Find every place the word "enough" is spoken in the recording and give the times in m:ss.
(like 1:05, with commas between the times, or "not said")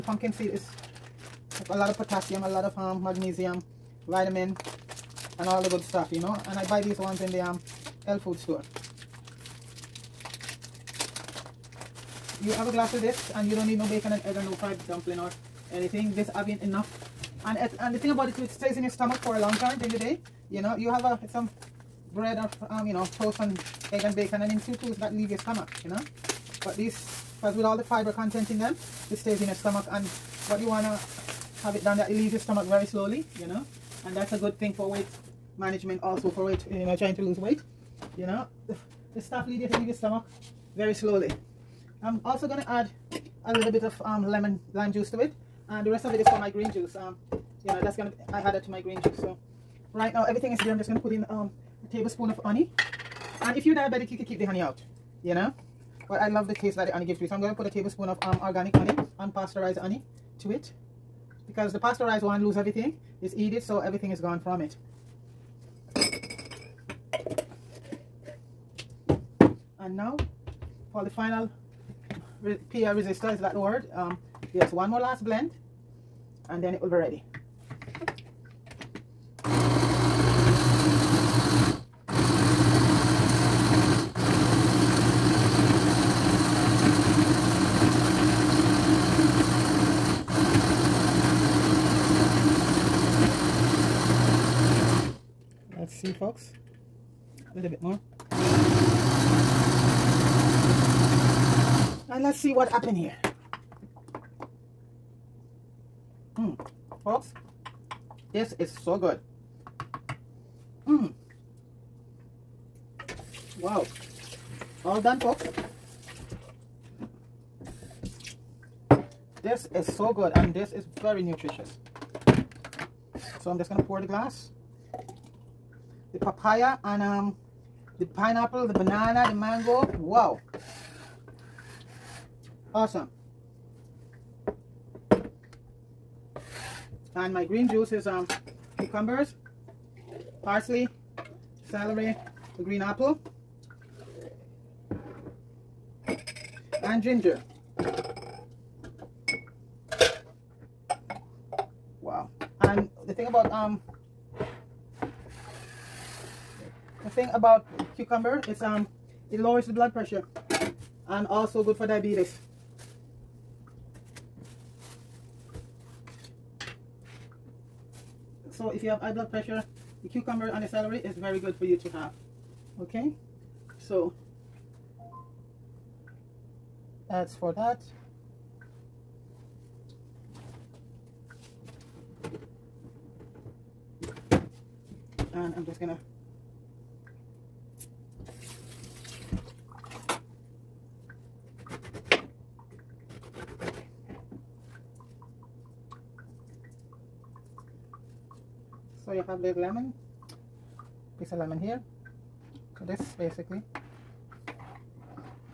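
0:16.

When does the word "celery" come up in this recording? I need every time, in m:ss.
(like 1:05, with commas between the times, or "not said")
2:21, 2:50.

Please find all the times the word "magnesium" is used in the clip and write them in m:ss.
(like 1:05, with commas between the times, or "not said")
0:03.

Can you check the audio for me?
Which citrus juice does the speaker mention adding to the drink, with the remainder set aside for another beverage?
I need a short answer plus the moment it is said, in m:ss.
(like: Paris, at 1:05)
lemon lime juice, at 0:44.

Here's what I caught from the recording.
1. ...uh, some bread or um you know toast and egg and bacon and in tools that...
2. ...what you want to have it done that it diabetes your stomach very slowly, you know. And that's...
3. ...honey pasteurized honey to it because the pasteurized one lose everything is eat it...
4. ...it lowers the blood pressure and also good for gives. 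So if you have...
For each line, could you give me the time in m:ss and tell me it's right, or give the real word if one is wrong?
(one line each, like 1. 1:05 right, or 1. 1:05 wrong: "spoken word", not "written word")
1. 0:21 right
2. 0:30 wrong: "leaves", not "diabetes"
3. 0:58 wrong: "unpasteurized", not "pasteurized"
4. 2:39 wrong: "diabetes", not "gives".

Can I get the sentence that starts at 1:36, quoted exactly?
see folks a little bit more and let's see what happened here Hmm, folks this is so good Hmm.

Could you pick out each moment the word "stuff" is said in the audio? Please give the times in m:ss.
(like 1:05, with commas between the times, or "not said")
0:05, 0:39.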